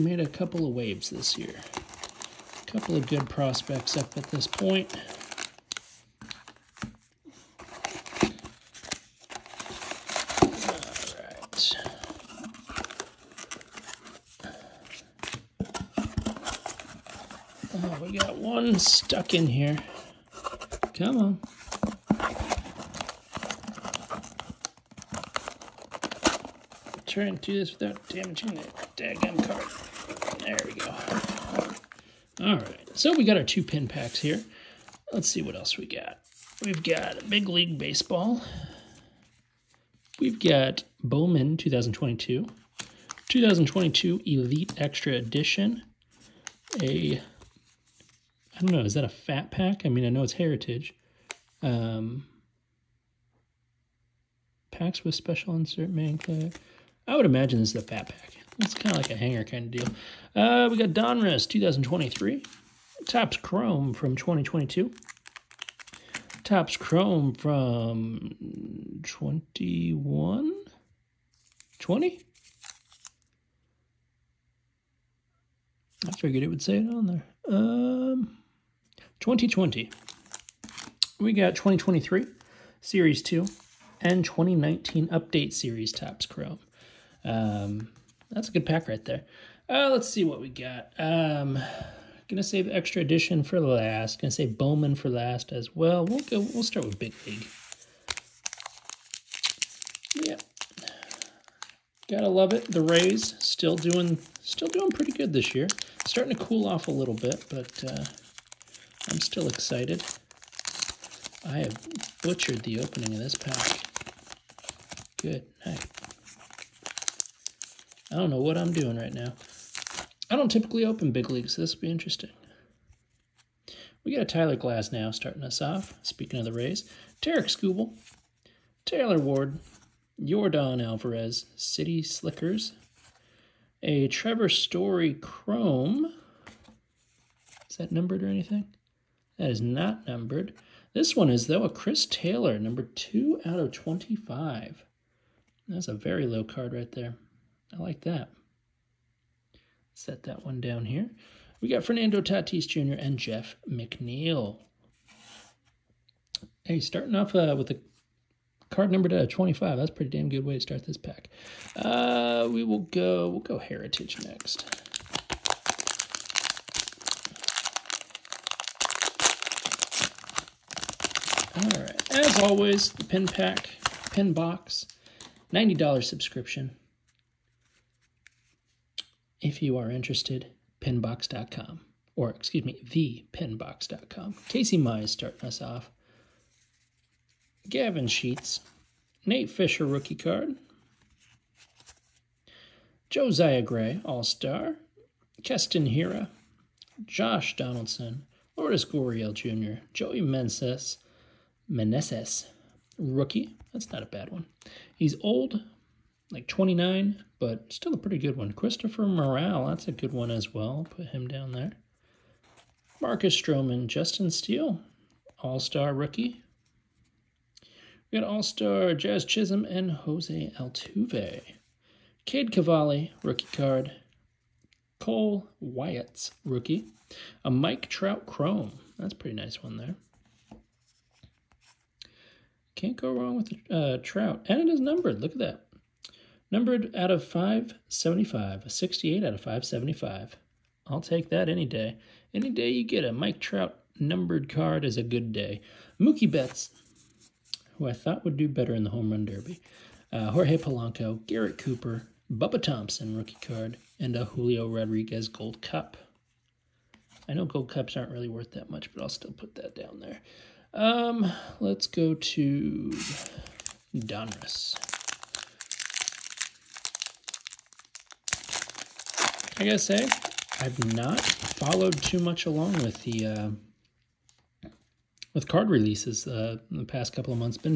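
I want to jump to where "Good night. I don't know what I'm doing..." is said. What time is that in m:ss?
1:55.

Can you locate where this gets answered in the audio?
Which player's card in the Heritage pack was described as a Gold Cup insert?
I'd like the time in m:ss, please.
4:14.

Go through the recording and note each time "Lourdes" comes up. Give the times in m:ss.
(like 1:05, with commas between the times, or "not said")
3:18.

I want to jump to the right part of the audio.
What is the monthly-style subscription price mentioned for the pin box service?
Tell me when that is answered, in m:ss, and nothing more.
2:55.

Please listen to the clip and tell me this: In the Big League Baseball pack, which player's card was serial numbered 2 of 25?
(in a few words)
Chris Taylor.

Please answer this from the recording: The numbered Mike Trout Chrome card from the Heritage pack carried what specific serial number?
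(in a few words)
68.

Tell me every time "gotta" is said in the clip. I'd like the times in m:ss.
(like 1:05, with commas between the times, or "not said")
1:42, 4:29.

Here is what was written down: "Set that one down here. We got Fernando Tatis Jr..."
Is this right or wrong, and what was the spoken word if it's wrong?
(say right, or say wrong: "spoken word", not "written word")
right.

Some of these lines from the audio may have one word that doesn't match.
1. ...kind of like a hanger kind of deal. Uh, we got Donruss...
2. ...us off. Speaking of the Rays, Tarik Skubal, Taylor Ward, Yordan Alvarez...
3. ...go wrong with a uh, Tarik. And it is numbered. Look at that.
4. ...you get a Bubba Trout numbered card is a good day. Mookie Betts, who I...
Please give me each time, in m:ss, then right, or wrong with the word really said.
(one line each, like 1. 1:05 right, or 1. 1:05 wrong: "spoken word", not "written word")
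1. 0:58 right
2. 2:05 right
3. 3:52 wrong: "Trout", not "Tarik"
4. 4:02 wrong: "Mike", not "Bubba".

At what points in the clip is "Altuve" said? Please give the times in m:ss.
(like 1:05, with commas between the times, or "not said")
3:40.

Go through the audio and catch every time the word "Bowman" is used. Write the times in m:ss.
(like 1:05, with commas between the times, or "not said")
0:41, 1:34.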